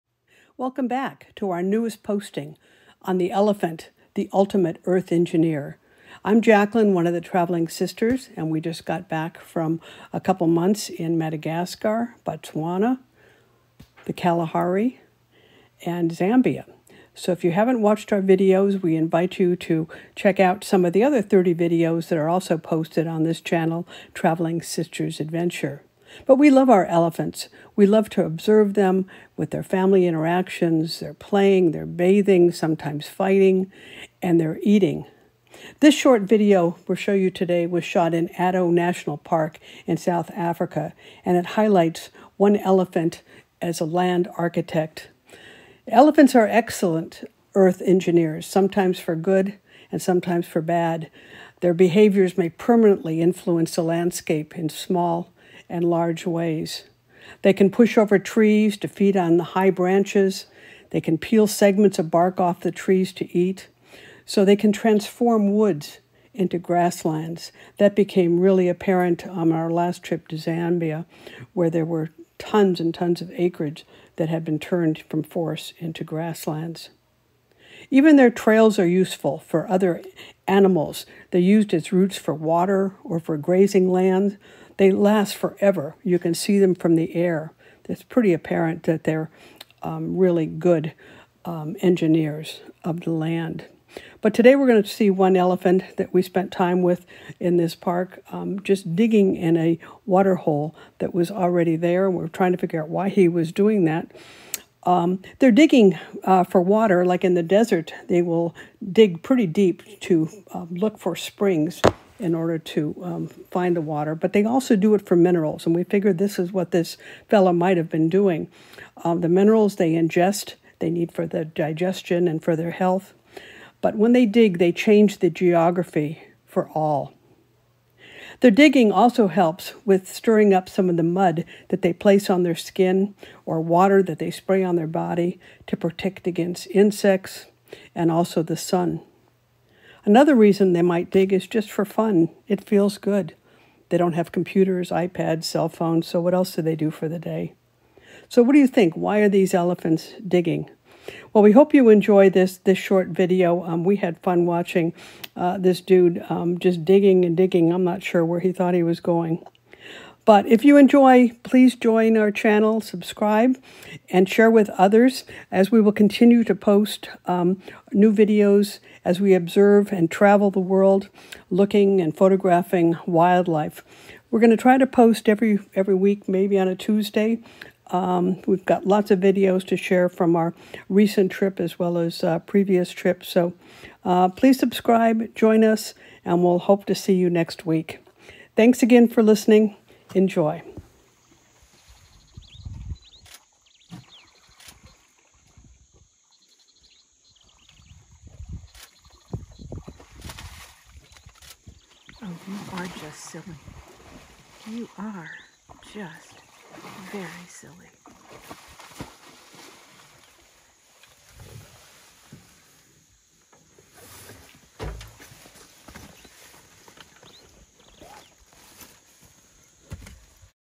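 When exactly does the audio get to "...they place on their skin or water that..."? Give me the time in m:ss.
2:11.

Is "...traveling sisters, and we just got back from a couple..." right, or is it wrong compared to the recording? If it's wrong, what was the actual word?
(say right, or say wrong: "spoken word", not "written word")
right.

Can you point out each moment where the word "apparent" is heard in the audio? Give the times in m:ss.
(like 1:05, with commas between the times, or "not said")
1:08, 1:28.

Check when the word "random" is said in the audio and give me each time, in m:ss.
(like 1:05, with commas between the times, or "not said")
not said.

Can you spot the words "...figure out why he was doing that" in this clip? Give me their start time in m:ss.
1:42.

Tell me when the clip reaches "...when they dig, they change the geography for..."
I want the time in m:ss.
2:03.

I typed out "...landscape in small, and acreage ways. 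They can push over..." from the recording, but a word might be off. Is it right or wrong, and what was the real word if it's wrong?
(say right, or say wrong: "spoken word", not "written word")
wrong: "large", not "acreage".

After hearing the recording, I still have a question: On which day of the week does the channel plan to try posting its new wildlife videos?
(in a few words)
Tuesday.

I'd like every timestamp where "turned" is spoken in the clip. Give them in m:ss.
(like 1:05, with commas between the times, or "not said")
1:14.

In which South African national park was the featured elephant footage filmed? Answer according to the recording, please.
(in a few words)
Addo National Park.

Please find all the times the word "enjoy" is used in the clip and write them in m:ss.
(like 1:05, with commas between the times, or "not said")
2:31, 2:40, 3:10.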